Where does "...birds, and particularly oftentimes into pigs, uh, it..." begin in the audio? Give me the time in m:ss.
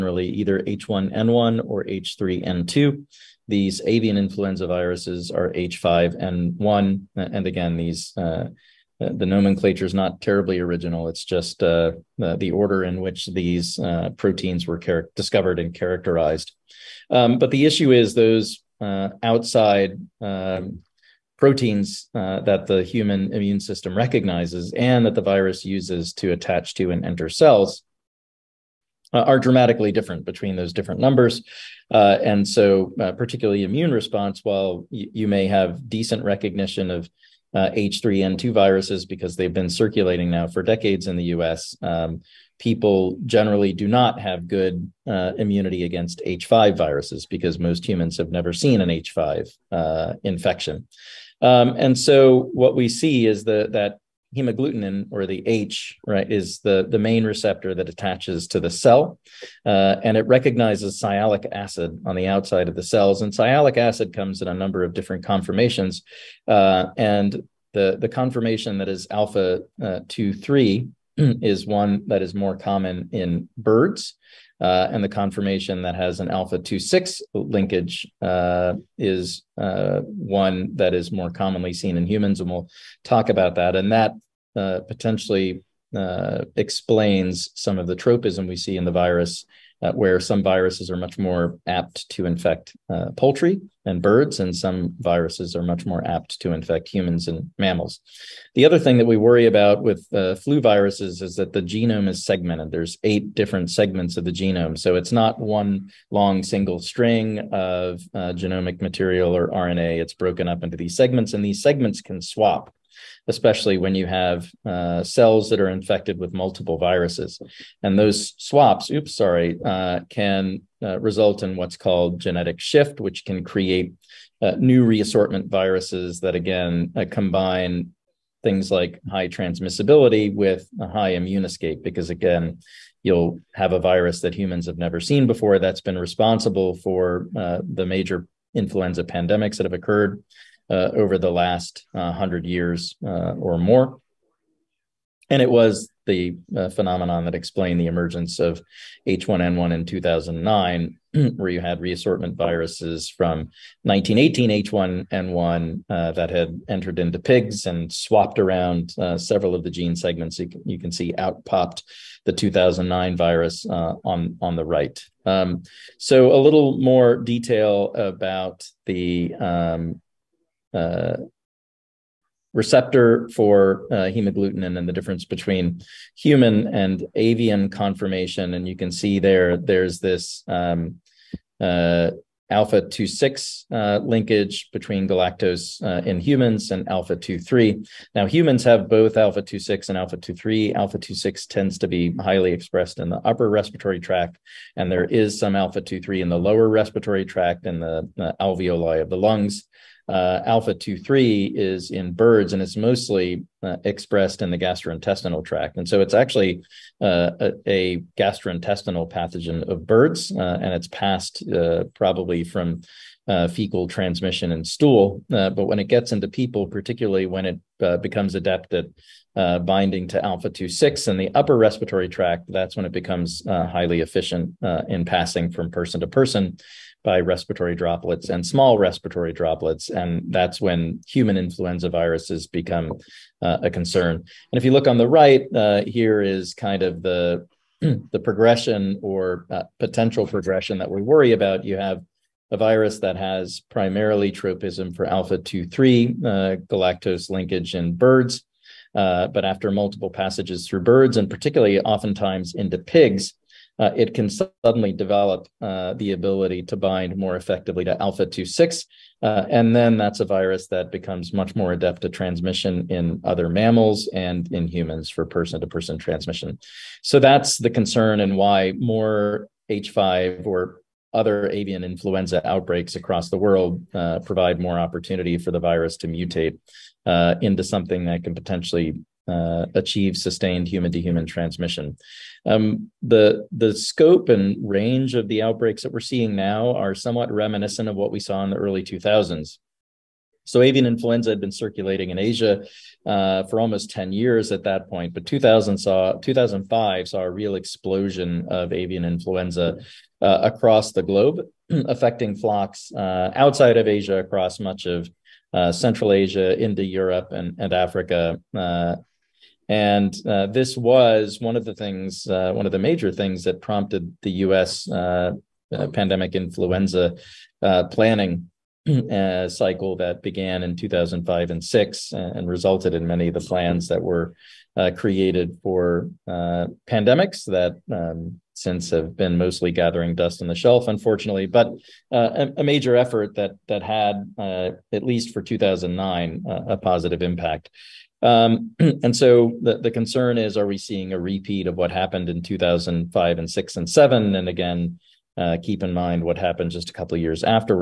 4:10.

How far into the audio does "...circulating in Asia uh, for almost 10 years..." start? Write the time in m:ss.
4:51.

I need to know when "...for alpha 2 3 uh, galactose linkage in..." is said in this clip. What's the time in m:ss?
4:04.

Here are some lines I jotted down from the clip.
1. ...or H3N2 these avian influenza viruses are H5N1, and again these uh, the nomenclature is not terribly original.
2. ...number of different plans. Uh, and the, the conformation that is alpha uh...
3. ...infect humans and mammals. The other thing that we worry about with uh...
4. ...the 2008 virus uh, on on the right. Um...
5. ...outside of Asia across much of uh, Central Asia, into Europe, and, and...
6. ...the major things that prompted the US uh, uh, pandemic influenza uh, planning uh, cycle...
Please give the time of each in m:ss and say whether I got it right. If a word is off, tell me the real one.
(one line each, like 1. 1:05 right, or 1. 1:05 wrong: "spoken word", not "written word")
1. 0:01 right
2. 1:04 wrong: "conformations", not "plans"
3. 1:36 right
4. 2:42 wrong: "2009", not "2008"
5. 5:03 right
6. 5:12 right.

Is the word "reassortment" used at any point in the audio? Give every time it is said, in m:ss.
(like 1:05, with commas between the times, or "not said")
2:04, 2:31.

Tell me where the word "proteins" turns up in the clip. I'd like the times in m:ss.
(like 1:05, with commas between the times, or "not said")
0:14, 0:21.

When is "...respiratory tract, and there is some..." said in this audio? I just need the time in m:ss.
3:13.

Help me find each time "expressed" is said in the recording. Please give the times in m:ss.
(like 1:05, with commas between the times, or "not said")
3:12, 3:23.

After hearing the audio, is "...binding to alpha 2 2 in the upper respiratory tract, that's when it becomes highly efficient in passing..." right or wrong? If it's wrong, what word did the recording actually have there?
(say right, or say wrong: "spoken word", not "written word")
wrong: "6", not "2".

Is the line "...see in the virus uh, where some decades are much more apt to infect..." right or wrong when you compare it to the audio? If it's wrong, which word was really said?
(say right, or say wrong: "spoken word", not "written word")
wrong: "viruses", not "decades".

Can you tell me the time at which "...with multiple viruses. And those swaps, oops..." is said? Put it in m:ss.
1:56.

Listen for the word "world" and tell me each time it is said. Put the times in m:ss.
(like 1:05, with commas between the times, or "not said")
4:33.